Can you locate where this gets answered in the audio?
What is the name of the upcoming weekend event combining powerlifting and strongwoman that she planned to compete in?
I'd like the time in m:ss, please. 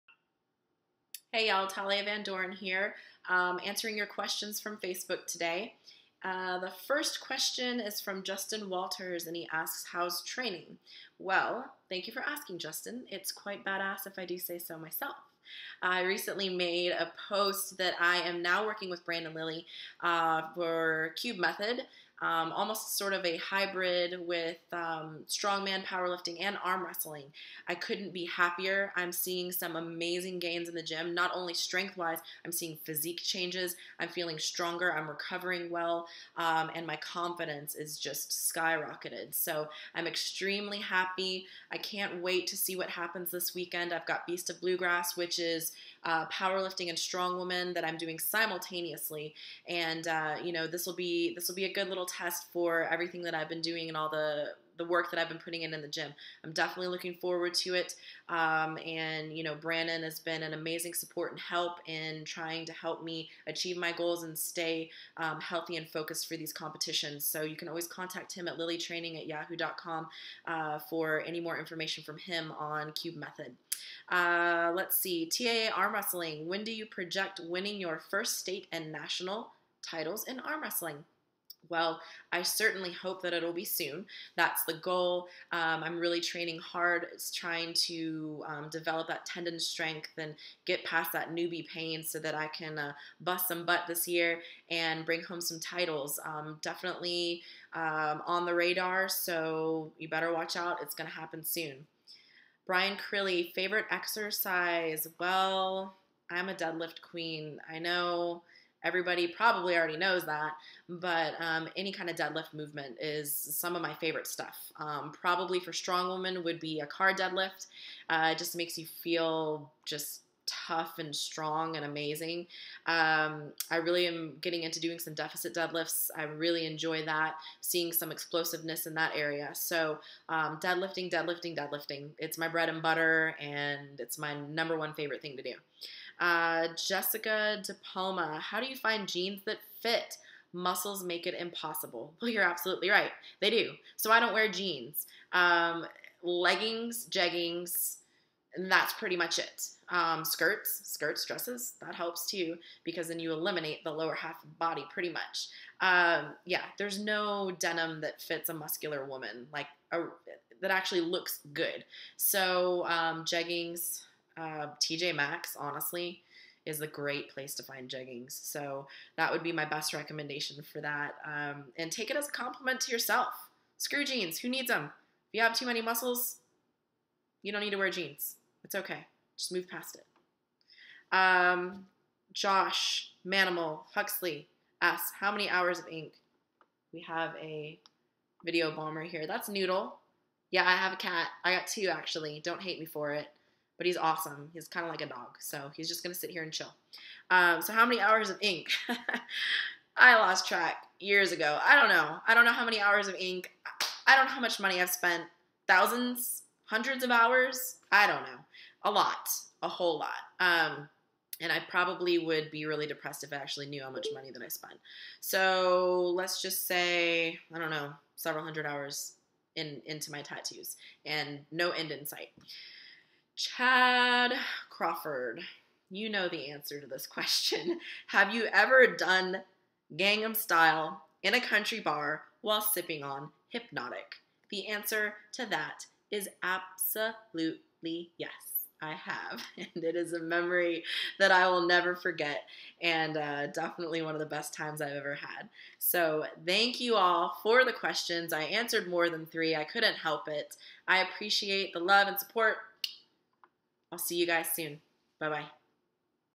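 0:44.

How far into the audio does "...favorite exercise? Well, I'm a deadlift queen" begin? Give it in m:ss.
1:43.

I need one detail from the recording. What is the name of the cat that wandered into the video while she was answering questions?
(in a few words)
Noodle.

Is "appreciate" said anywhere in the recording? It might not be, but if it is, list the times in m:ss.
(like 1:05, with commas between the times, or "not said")
4:10.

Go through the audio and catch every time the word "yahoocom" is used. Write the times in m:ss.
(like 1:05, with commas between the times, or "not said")
1:09.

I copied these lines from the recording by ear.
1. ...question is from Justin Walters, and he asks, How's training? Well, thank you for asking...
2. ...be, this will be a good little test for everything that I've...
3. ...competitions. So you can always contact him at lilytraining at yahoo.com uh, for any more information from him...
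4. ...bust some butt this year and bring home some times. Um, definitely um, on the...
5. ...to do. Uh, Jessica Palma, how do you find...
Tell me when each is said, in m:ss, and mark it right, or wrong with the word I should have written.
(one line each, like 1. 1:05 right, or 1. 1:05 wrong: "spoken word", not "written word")
1. 0:07 right
2. 0:50 right
3. 1:06 right
4. 1:33 wrong: "titles", not "times"
5. 2:15 right.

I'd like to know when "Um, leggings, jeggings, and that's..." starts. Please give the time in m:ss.
2:25.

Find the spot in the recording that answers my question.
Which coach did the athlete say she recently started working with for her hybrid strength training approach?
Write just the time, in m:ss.
0:19.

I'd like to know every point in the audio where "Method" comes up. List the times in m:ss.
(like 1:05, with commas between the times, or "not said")
0:21, 1:13.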